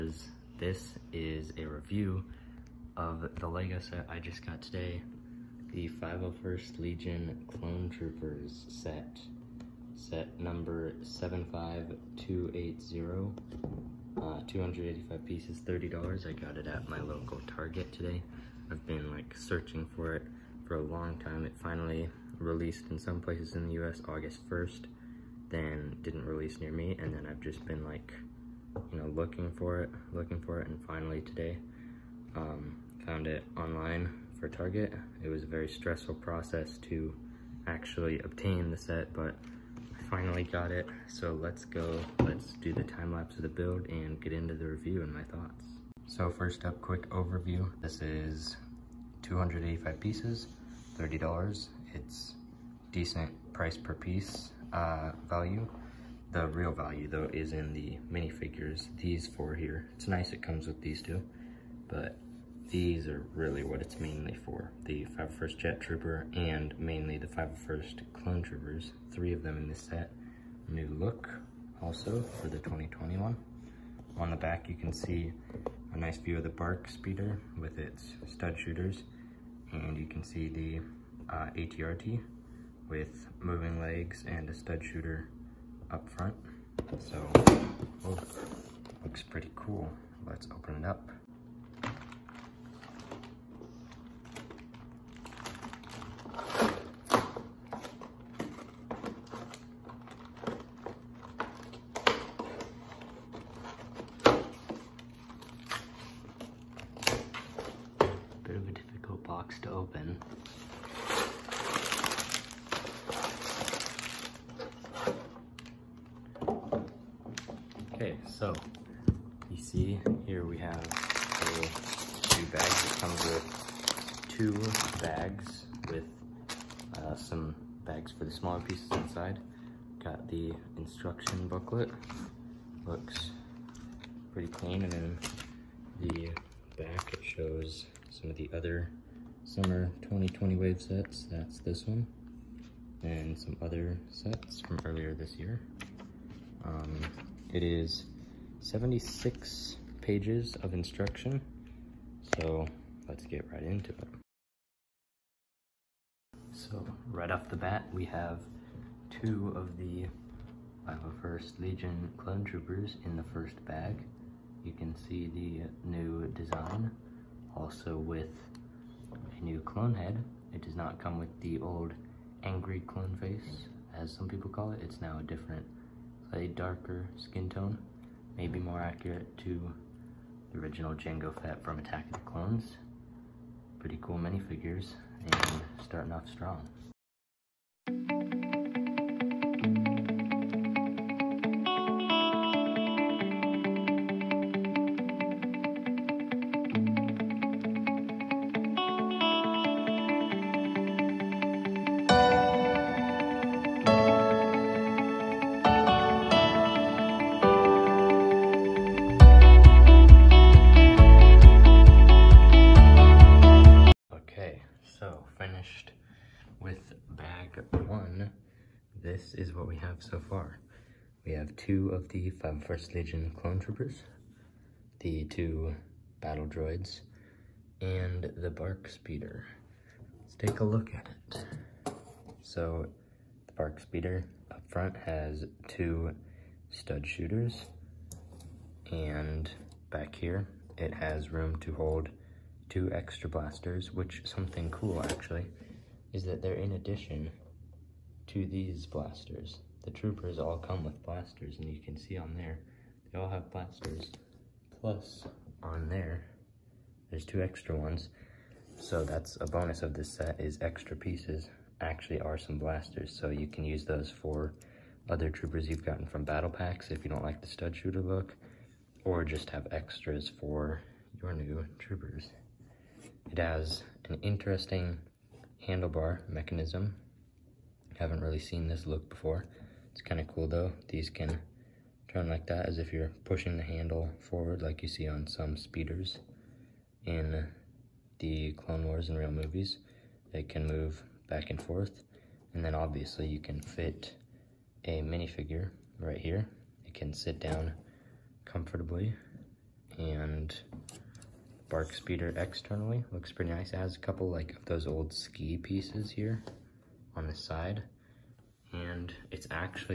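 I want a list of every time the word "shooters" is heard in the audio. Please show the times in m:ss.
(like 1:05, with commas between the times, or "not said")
1:18, 1:24, 3:57, 4:27.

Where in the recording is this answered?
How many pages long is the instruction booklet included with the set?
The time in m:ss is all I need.
2:28.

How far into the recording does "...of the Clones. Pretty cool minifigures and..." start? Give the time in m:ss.
3:02.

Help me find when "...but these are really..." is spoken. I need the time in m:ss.
1:01.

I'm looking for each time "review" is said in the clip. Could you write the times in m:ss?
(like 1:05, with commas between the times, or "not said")
0:01, 0:44.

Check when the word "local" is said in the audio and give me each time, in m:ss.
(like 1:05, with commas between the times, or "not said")
0:17.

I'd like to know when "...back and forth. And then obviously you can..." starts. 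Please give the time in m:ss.
4:51.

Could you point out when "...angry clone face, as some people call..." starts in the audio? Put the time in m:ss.
2:52.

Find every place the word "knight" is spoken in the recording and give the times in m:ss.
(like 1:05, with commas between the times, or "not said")
not said.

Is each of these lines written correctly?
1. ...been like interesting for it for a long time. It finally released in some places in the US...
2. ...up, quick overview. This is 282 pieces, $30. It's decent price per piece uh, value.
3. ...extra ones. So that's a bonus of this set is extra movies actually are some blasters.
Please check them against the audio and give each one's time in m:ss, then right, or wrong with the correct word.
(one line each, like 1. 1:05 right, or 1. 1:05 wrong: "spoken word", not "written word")
1. 0:18 wrong: "searching", not "interesting"
2. 0:46 wrong: "285", not "282"
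3. 4:17 wrong: "pieces", not "movies".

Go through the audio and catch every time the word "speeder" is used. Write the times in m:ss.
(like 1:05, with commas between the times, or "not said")
1:16, 3:48, 3:53, 4:45, 5:01.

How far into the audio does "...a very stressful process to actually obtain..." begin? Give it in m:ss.
0:35.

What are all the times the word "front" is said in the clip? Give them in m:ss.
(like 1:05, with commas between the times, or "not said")
1:26, 3:54.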